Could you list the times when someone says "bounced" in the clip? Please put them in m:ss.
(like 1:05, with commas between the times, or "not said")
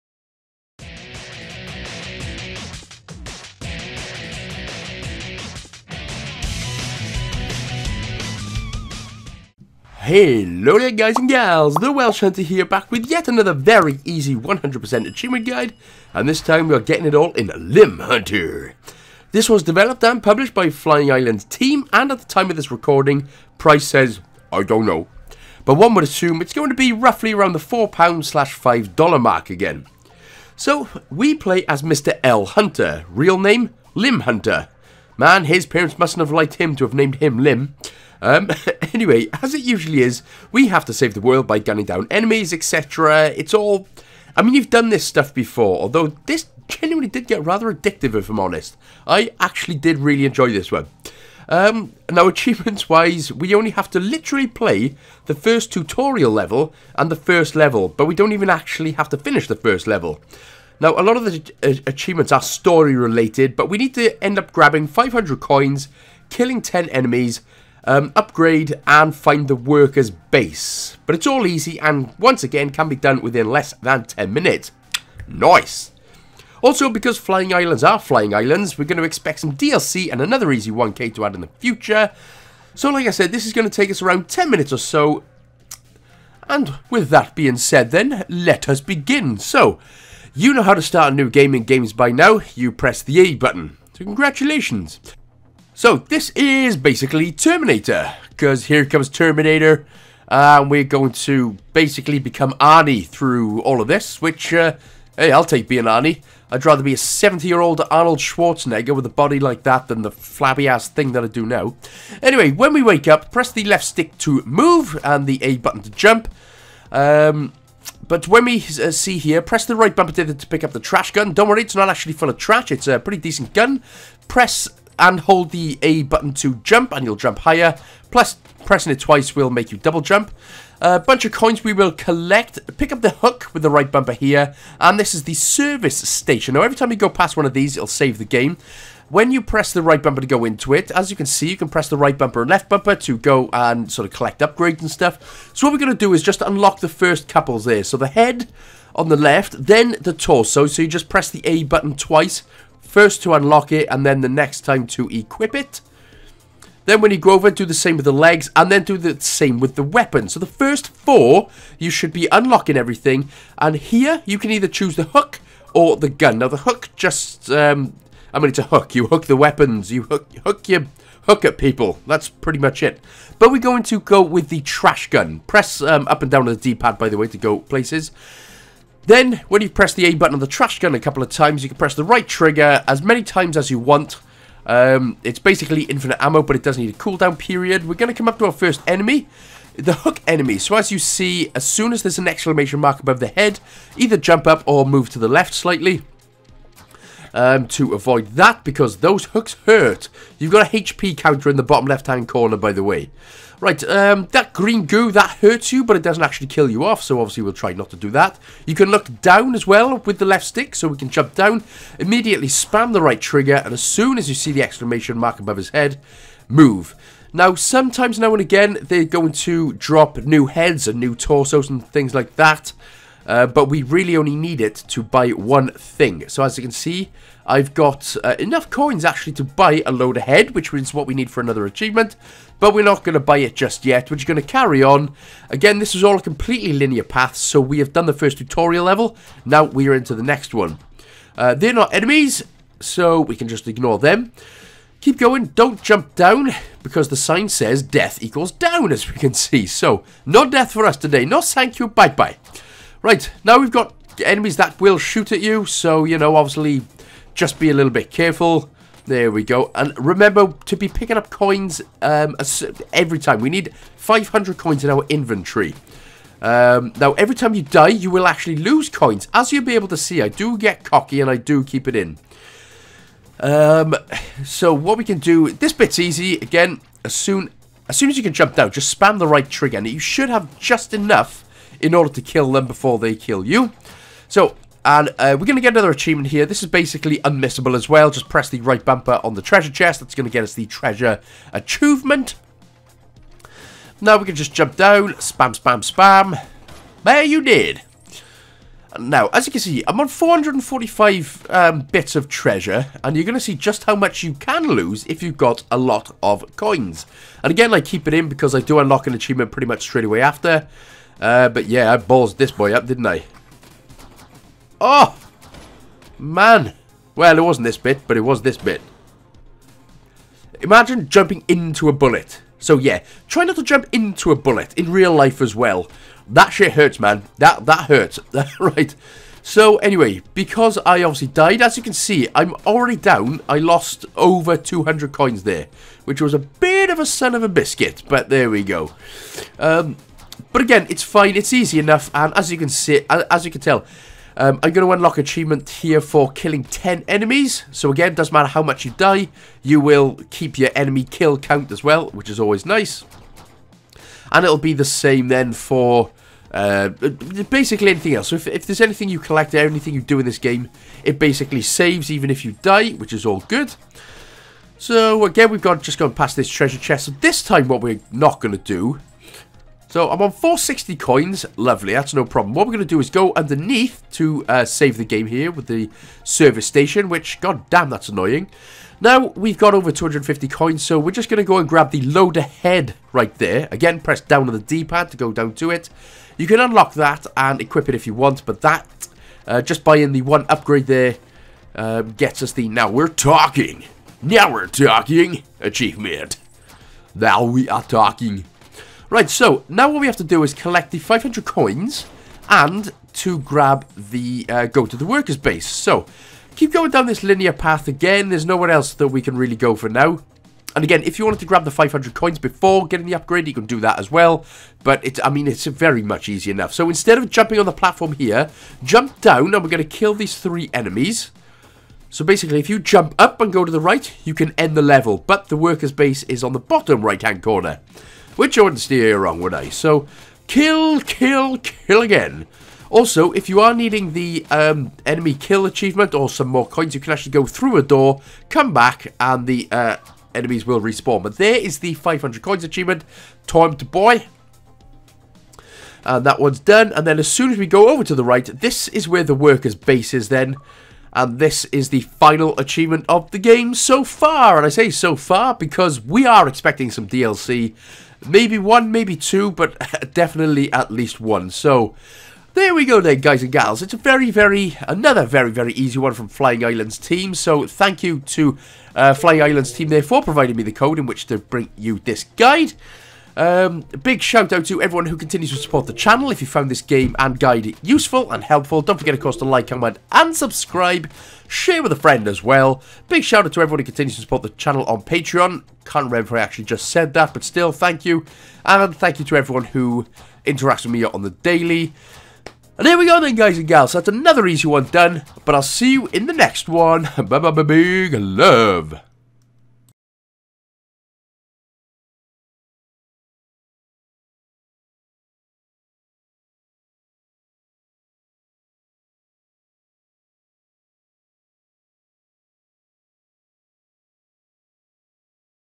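not said.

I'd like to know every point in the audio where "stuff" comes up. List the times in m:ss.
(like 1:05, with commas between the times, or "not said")
0:45, 2:24.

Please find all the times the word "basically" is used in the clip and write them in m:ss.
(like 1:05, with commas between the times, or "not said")
1:36, 1:41, 3:05, 4:46, 5:56, 6:01, 7:02.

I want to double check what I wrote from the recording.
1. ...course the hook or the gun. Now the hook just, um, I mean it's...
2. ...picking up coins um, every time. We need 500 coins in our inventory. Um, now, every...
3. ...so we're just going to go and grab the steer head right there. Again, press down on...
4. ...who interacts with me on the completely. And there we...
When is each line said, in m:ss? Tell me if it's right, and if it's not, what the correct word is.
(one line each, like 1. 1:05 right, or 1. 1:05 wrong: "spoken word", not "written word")
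1. 2:44 wrong: "choose", not "course"
2. 4:20 right
3. 6:20 wrong: "loader", not "steer"
4. 8:09 wrong: "daily", not "completely".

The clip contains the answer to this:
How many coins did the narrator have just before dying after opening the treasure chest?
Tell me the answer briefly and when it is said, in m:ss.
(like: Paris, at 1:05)
445, at 5:00.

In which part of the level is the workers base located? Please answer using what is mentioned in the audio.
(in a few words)
bottom right-hand corner.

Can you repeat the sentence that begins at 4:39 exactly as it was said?
And you should have just enough in order to kill them before they kill you.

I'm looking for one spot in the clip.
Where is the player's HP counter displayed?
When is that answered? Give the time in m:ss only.
3:21.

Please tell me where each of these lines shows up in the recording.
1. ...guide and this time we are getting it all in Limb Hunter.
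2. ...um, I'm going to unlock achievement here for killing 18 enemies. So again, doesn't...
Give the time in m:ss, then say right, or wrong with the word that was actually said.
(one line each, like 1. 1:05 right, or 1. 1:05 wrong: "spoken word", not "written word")
1. 0:15 right
2. 5:44 wrong: "10", not "18".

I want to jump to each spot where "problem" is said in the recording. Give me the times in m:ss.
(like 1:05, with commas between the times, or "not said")
6:12.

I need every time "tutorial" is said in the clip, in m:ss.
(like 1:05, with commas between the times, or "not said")
0:55, 3:58.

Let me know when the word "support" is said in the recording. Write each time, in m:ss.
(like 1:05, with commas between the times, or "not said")
7:55, 8:04.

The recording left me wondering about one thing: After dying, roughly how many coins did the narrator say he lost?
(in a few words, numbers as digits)
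over 200.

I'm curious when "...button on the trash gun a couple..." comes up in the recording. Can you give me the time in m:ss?
3:00.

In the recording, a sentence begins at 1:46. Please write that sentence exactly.
I'd rather be a 70-year-old Arnold Schwarzenegger with a body like that than the flabby-ass thing that I do now.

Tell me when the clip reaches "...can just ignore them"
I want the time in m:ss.
4:03.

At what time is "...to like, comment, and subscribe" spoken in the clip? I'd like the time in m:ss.
7:59.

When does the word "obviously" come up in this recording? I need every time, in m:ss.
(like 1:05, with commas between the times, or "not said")
3:27, 4:16, 5:31.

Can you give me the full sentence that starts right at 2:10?
A bunch of coins we will collect.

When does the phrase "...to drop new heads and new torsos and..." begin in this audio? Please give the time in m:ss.
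3:39.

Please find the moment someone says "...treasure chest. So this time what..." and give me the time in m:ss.
6:06.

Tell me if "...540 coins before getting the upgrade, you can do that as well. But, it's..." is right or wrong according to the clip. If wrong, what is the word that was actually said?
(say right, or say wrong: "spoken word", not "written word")
wrong: "500", not "540".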